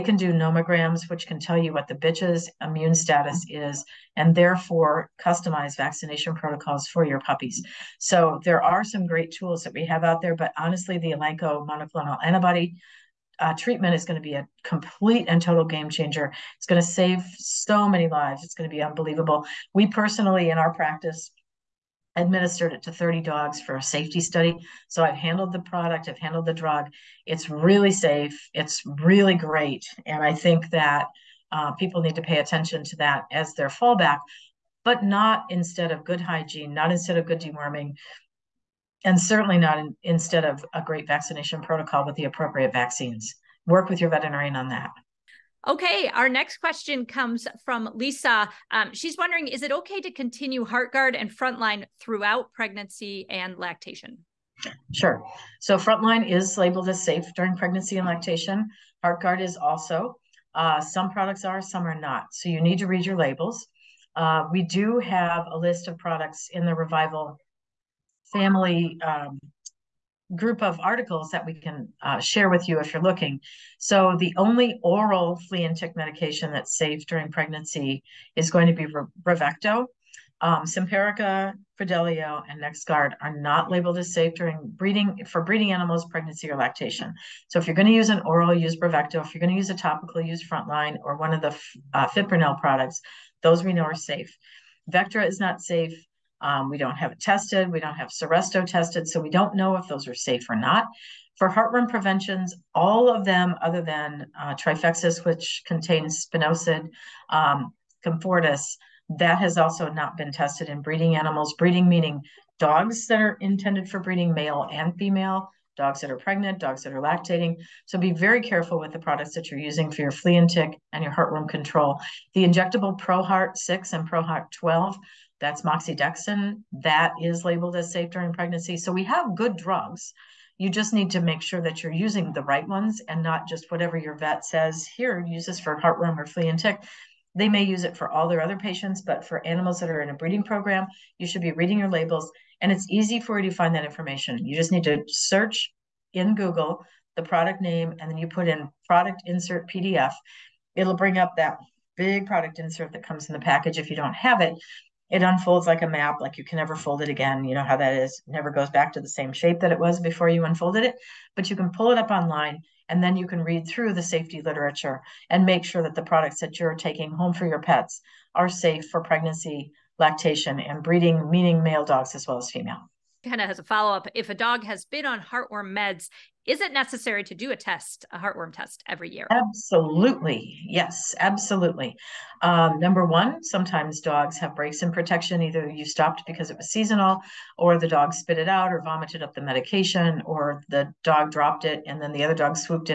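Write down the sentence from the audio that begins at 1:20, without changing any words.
Um, Simparica, Credelio, and NexGard are not labeled as safe during breeding for breeding animals, pregnancy, or lactation.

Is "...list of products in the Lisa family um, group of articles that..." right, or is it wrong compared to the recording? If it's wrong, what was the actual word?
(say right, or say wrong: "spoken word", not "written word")
wrong: "Revival", not "Lisa".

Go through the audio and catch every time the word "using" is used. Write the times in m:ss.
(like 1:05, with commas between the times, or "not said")
1:59, 2:11.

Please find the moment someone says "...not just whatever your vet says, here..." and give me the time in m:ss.
2:13.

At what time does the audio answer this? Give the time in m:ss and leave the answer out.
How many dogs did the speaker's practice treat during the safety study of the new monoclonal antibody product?
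0:22.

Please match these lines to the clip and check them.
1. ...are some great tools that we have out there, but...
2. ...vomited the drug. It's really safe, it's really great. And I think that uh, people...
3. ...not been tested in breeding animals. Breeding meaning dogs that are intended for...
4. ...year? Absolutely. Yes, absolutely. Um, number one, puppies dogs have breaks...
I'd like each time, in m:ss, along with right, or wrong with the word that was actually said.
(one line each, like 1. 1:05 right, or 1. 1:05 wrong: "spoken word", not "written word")
1. 0:08 right
2. 0:26 wrong: "handled", not "vomited"
3. 1:49 right
4. 2:59 wrong: "sometimes", not "puppies".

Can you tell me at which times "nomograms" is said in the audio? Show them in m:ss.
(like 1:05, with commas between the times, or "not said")
0:00.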